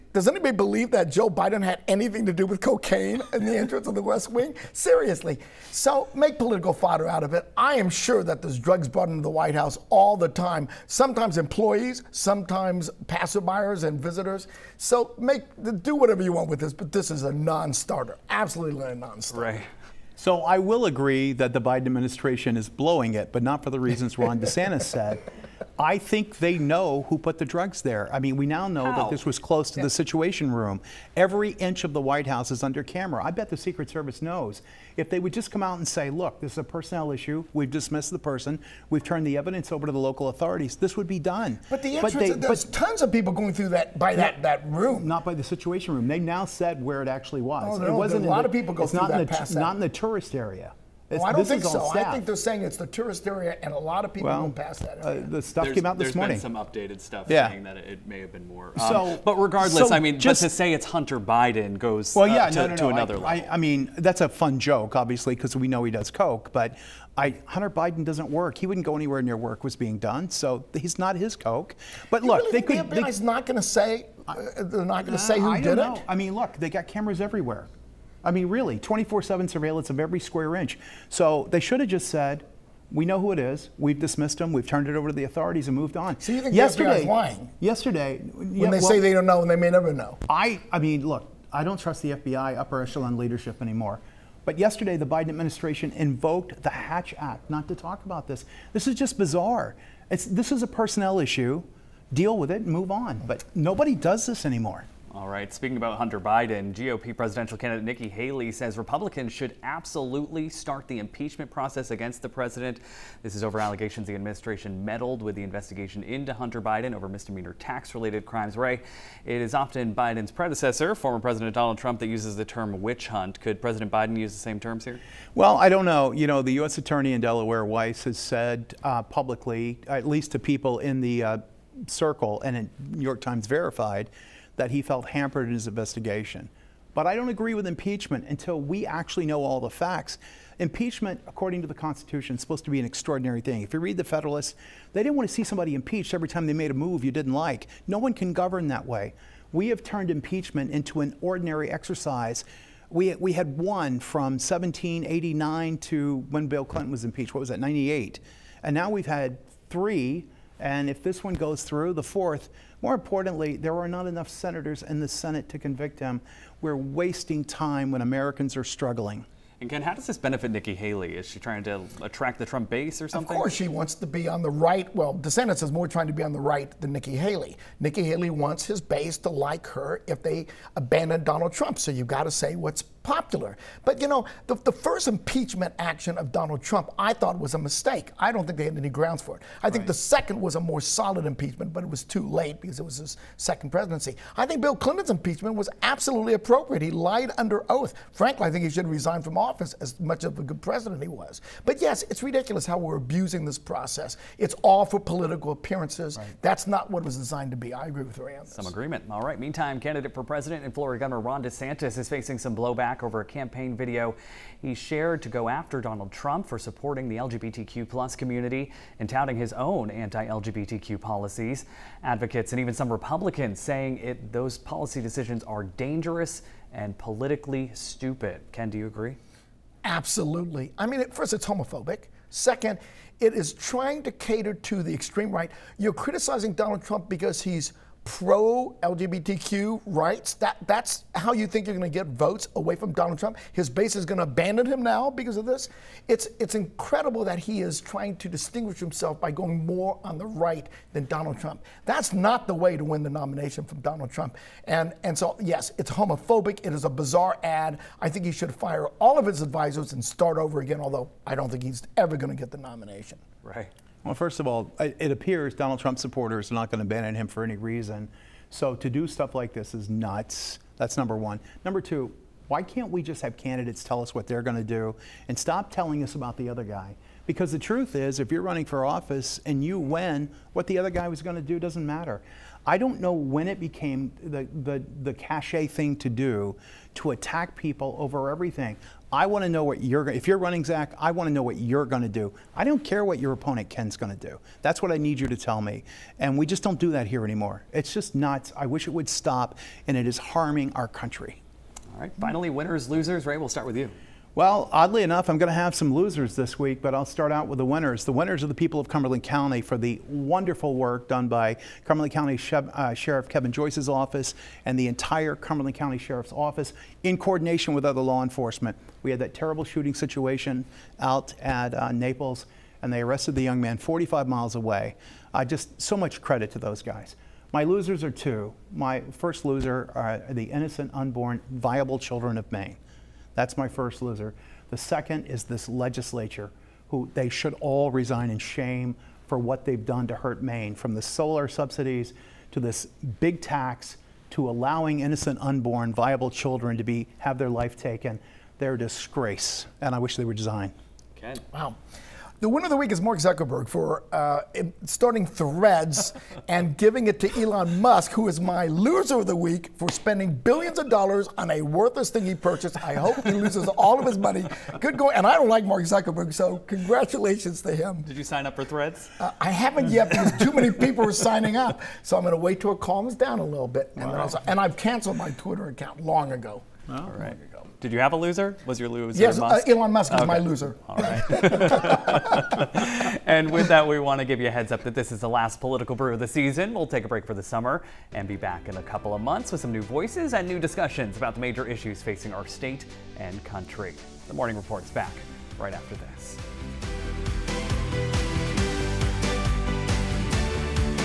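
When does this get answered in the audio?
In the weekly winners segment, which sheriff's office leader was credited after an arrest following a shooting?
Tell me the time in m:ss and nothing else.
5:13.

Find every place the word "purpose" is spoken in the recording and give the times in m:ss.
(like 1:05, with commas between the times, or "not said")
not said.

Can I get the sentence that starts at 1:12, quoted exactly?
The FBI's they, not going to say.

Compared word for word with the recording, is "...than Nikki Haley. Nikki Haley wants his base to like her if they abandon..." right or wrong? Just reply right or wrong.
right.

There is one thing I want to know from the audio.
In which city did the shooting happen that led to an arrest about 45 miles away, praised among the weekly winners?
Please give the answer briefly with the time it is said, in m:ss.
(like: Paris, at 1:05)
Naples, at 5:21.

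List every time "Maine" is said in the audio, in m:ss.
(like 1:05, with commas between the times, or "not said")
5:32, 5:40.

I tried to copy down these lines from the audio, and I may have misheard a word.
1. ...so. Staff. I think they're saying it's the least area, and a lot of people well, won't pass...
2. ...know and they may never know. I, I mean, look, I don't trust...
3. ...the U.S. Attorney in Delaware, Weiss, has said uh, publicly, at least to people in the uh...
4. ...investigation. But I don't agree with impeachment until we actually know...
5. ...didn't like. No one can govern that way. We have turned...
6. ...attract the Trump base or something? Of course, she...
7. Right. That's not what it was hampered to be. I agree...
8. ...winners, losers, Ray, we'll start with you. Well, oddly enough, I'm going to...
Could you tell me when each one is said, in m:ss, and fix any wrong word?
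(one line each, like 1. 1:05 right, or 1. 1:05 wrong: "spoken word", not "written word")
1. 0:51 wrong: "tourist", not "least"
2. 1:29 right
3. 2:06 right
4. 2:15 right
5. 2:27 right
6. 2:52 right
7. 3:26 wrong: "designed", not "hampered"
8. 5:02 right.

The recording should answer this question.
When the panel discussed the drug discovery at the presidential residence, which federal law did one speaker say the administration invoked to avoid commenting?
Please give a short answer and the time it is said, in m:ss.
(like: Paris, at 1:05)
Hatch Act, at 1:36.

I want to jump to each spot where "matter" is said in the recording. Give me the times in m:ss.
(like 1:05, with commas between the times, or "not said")
4:41.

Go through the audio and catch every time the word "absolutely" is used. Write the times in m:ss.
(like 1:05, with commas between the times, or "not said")
0:18, 1:49, 3:15, 3:49.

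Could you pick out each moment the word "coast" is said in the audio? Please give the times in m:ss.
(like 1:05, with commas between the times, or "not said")
not said.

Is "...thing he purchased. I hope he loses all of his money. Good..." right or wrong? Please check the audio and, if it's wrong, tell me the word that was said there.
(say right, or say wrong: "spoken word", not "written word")
right.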